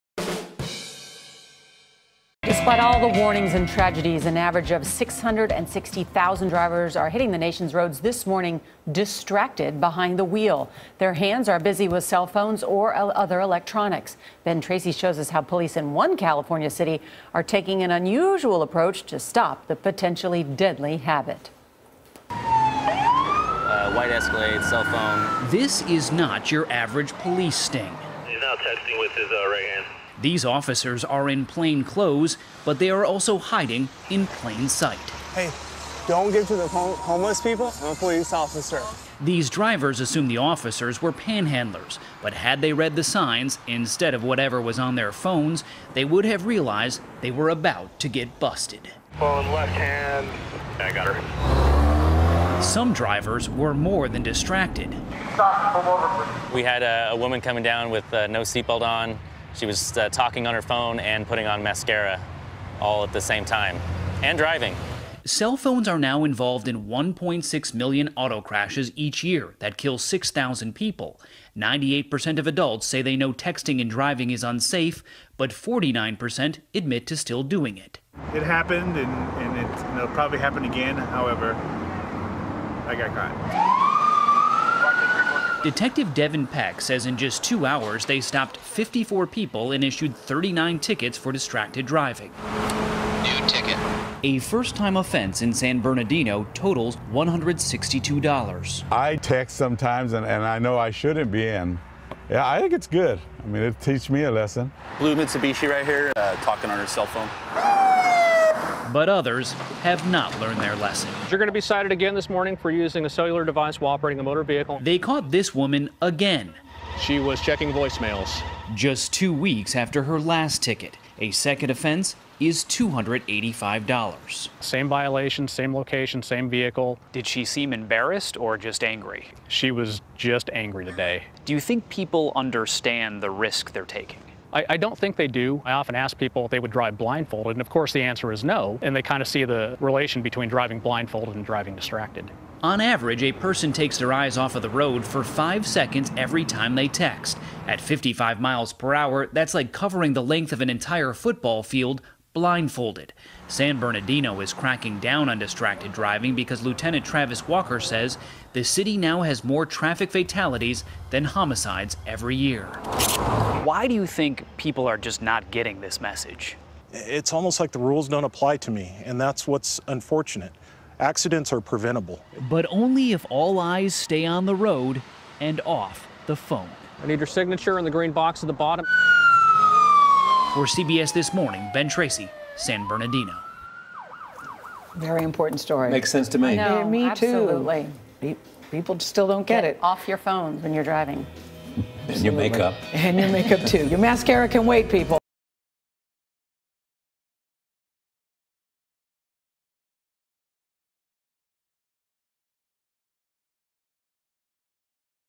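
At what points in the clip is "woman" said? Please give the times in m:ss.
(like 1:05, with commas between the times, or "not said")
0:57, 1:55.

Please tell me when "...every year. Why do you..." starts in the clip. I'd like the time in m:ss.
2:42.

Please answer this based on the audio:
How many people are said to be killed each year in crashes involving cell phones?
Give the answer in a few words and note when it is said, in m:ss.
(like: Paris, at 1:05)
6,000, at 1:09.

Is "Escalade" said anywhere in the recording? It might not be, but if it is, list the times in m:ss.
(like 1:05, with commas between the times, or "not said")
0:24.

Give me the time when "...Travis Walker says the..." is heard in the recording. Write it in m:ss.
2:37.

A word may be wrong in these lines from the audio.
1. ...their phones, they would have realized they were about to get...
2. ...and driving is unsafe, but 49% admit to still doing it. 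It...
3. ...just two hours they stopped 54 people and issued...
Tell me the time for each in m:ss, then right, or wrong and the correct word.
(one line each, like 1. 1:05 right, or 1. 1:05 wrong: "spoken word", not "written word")
1. 0:44 right
2. 1:13 right
3. 1:27 right.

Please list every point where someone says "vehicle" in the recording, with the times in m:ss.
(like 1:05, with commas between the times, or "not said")
1:54, 2:06.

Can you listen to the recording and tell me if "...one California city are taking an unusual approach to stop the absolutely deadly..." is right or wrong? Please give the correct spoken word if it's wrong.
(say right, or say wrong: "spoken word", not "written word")
wrong: "potentially", not "absolutely".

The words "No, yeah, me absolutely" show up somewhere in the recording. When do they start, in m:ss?
3:06.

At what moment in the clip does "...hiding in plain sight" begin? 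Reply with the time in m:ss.
0:33.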